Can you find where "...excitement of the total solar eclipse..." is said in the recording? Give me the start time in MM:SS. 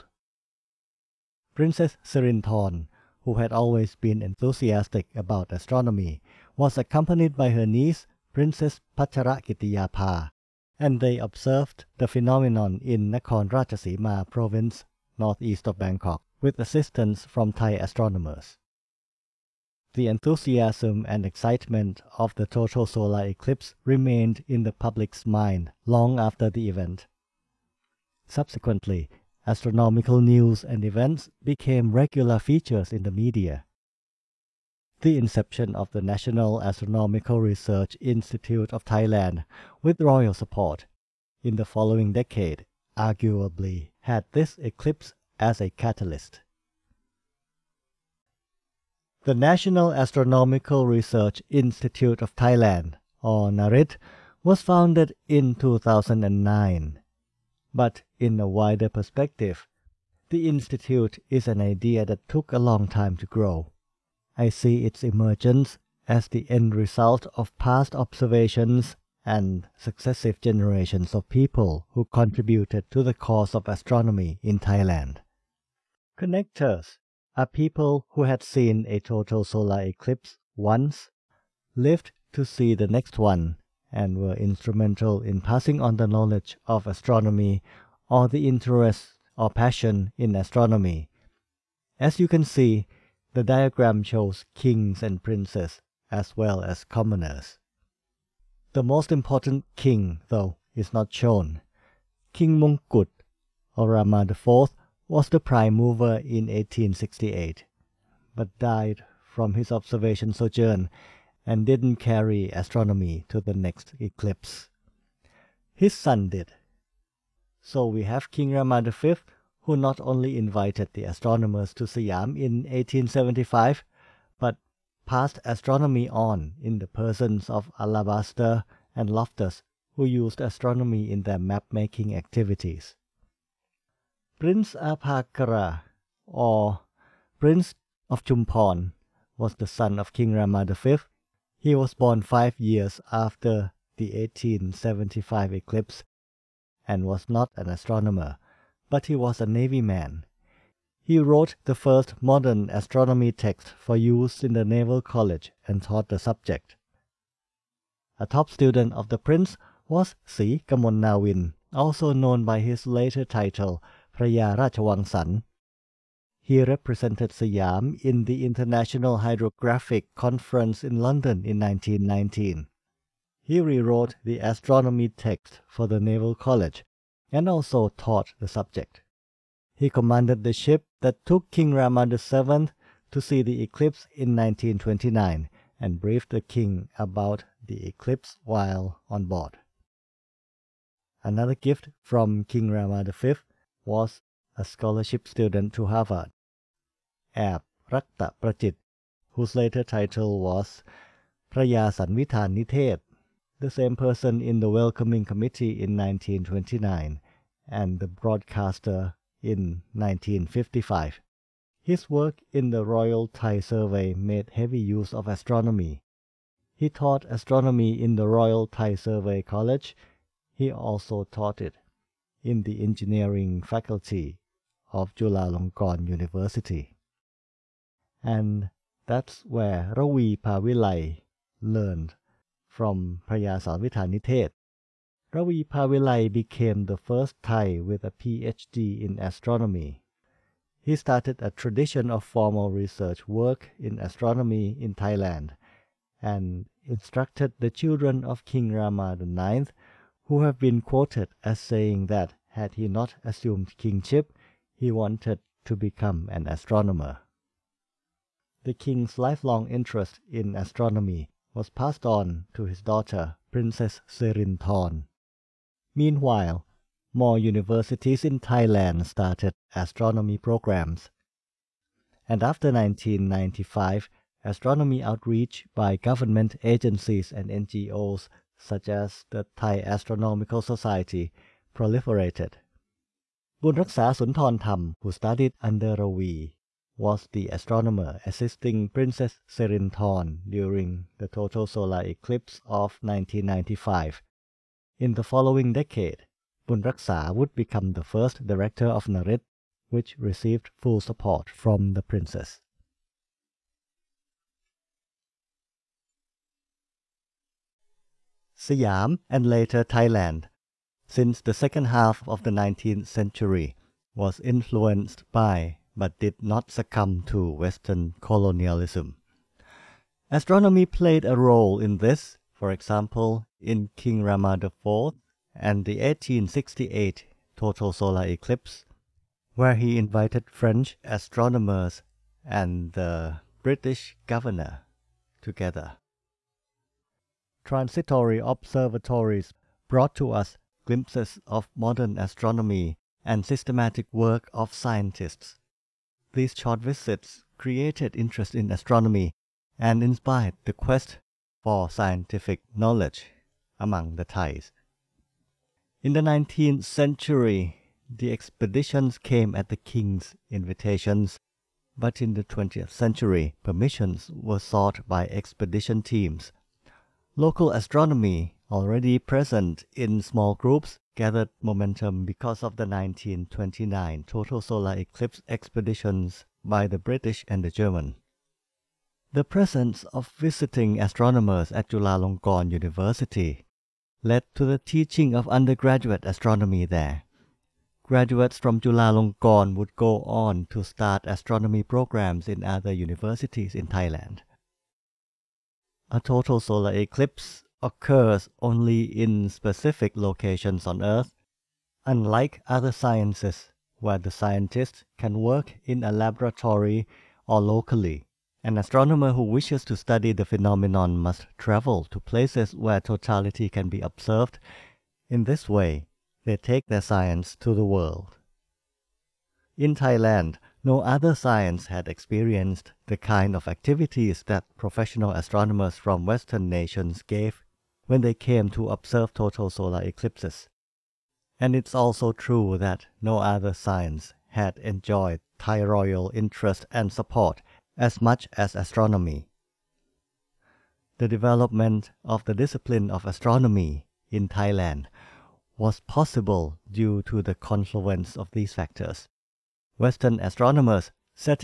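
00:21.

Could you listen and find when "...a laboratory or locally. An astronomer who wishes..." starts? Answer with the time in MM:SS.
06:46.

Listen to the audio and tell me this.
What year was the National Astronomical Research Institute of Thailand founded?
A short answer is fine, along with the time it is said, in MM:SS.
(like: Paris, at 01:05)
2009, at 00:55.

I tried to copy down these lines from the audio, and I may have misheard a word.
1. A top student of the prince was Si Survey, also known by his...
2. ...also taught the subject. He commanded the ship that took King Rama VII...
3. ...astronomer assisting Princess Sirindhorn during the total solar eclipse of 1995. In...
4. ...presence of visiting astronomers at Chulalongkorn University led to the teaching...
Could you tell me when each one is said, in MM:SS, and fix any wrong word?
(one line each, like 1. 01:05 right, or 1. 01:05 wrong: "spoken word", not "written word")
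1. 02:38 wrong: "Nawin", not "Survey"
2. 02:57 right
3. 04:47 right
4. 06:19 right.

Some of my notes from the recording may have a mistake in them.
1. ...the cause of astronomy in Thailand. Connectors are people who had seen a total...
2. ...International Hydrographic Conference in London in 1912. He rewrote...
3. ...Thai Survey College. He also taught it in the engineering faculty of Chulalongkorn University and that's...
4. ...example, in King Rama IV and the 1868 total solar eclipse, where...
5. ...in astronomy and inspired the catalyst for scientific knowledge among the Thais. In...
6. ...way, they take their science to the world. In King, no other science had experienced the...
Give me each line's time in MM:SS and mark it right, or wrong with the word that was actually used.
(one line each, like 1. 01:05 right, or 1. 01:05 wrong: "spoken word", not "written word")
1. 01:13 right
2. 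02:48 wrong: "1919", not "1912"
3. 03:38 right
4. 05:22 right
5. 05:48 wrong: "quest", not "catalyst"
6. 06:55 wrong: "Thailand", not "King".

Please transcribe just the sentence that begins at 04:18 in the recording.
The king's lifelong interest in astronomy was passed on to his daughter, Princess Serinthorn.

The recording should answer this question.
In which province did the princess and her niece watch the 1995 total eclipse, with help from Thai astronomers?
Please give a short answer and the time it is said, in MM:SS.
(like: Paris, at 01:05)
Nakhon Ratchasima, at 00:13.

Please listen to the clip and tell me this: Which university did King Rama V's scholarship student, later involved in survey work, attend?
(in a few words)
Harvard.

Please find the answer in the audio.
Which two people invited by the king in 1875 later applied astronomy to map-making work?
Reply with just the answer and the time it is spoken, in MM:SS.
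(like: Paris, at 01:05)
Alabaster and Loftus, at 02:07.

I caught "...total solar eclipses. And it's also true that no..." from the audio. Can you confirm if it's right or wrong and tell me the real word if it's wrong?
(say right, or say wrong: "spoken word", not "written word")
right.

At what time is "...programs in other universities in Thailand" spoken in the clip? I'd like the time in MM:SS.
06:31.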